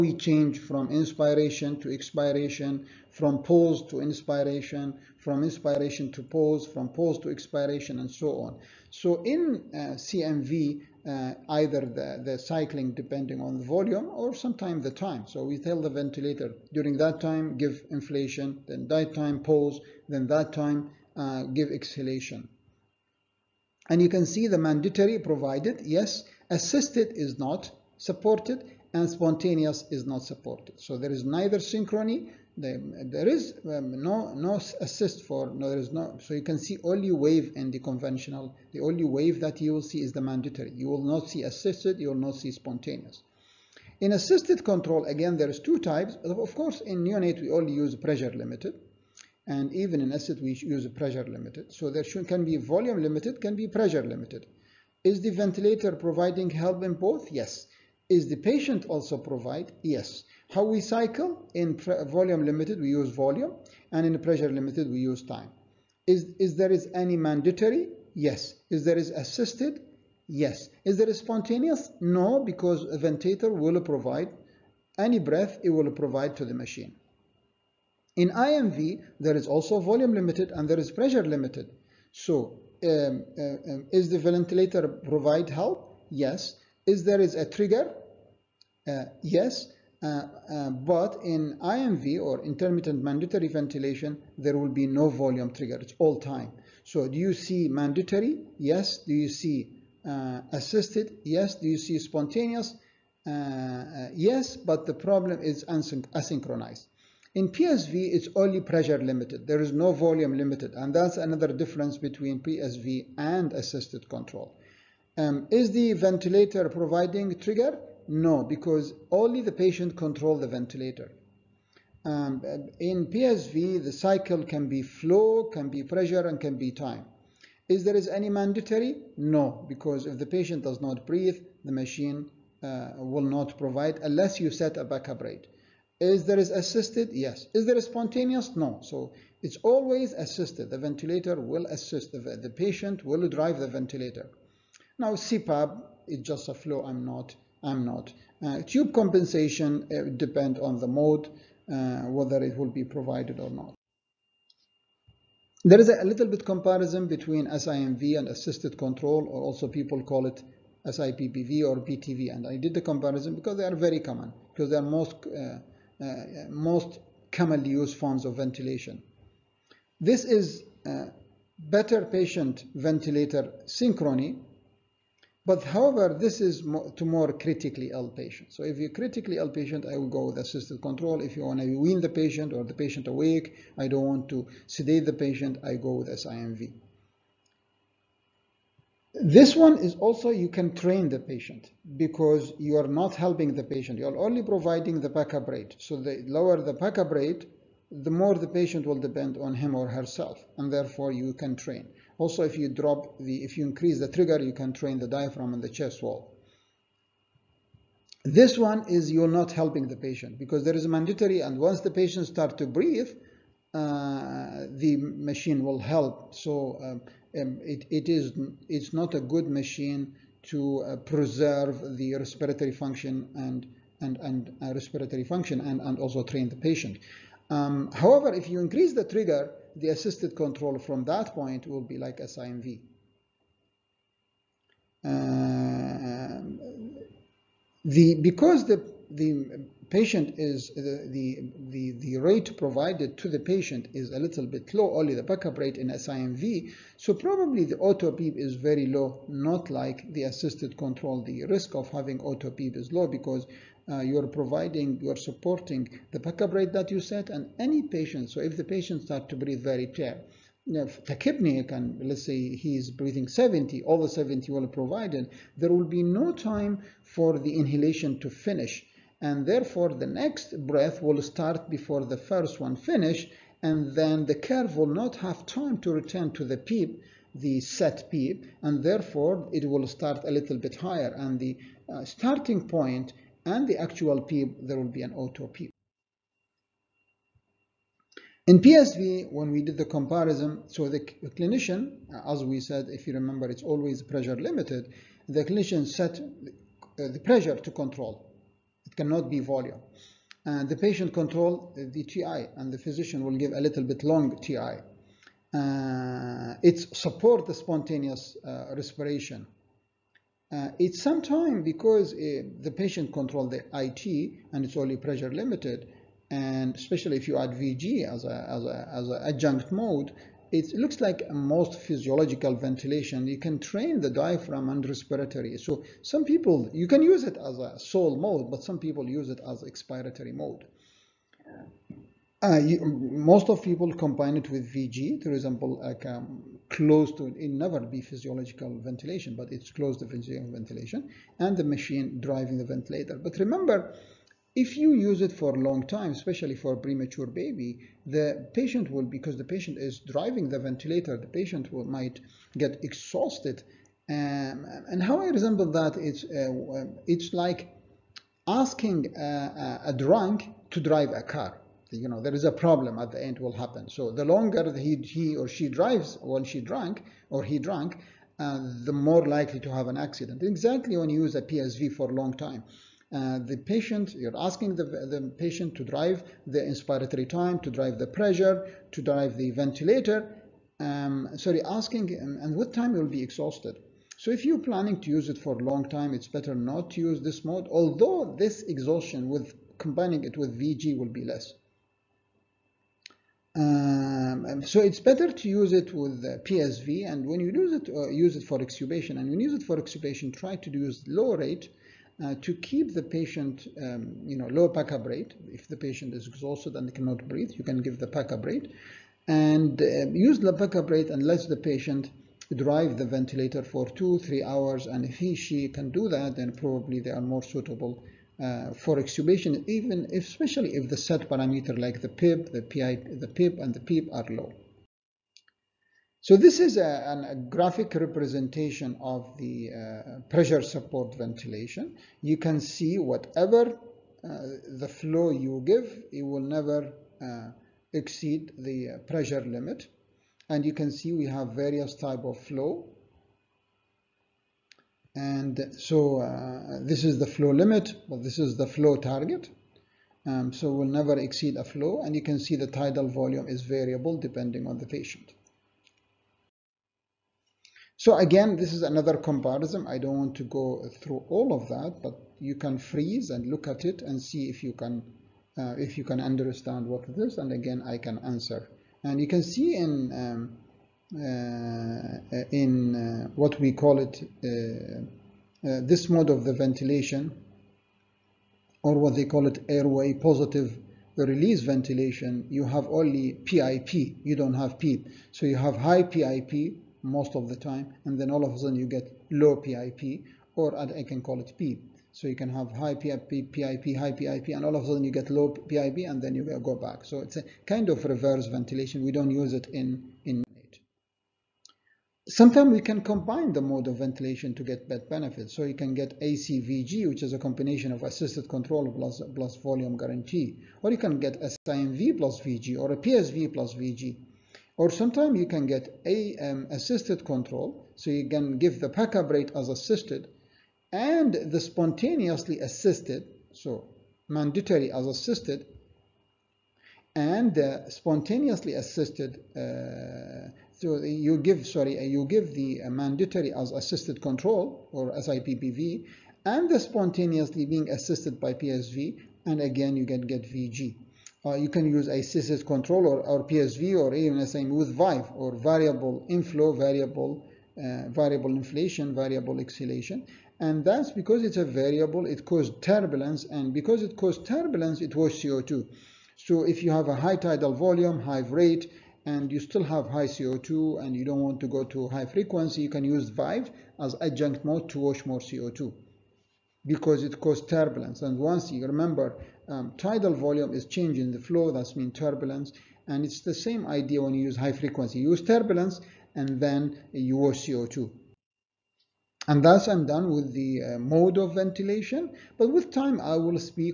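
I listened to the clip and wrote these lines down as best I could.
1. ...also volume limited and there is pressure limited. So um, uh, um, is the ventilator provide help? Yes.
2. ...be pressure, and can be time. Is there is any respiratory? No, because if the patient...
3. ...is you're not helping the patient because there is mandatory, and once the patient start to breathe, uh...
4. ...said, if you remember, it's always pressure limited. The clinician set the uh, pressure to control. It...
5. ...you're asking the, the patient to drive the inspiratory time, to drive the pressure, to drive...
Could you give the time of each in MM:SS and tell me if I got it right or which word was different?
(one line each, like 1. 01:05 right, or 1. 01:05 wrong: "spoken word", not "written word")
1. 01:19 right
2. 02:05 wrong: "mandatory", not "respiratory"
3. 03:28 right
4. 04:52 right
5. 06:14 right.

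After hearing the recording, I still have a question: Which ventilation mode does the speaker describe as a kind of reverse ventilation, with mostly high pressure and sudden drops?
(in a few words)
Airway positive release ventilation.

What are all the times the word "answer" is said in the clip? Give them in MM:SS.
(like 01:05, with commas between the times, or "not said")
07:48.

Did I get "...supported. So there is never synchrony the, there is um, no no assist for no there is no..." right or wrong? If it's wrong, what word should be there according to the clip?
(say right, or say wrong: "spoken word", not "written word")
wrong: "neither", not "never".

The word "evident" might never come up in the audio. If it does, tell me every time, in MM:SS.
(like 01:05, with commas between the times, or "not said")
not said.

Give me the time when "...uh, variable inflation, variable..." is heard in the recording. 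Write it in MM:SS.
09:07.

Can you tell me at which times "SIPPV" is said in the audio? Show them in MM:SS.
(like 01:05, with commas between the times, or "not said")
02:40, 08:55.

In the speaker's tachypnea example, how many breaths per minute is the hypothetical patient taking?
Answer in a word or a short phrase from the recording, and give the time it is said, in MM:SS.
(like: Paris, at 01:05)
70, at 04:22.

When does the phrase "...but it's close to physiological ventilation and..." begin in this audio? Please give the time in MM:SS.
05:39.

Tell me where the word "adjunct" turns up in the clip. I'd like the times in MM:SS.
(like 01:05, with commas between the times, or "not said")
05:19, 09:24.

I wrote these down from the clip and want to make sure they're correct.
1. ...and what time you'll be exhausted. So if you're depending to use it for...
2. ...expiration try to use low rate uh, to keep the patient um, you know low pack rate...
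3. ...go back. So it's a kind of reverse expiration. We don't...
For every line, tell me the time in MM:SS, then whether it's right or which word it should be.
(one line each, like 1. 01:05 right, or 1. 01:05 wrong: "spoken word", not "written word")
1. 06:22 wrong: "planning", not "depending"
2. 06:39 wrong: "extubation", not "expiration"
3. 08:16 wrong: "ventilation", not "expiration".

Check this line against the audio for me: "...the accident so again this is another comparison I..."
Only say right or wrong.
wrong.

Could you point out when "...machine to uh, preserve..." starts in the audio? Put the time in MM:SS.
03:39.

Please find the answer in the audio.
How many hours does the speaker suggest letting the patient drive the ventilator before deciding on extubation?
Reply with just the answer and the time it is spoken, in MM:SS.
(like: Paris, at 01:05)
2 to 3 hours, at 06:53.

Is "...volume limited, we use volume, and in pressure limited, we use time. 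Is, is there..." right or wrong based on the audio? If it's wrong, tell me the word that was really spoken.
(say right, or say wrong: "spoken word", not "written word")
right.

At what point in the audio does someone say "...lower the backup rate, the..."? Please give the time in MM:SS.
03:16.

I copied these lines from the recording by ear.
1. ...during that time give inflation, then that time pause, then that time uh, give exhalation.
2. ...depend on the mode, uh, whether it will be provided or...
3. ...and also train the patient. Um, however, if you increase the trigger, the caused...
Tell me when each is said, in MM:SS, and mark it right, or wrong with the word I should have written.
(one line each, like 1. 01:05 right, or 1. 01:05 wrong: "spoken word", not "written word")
1. 00:16 right
2. 02:30 right
3. 03:45 wrong: "assisted", not "caused".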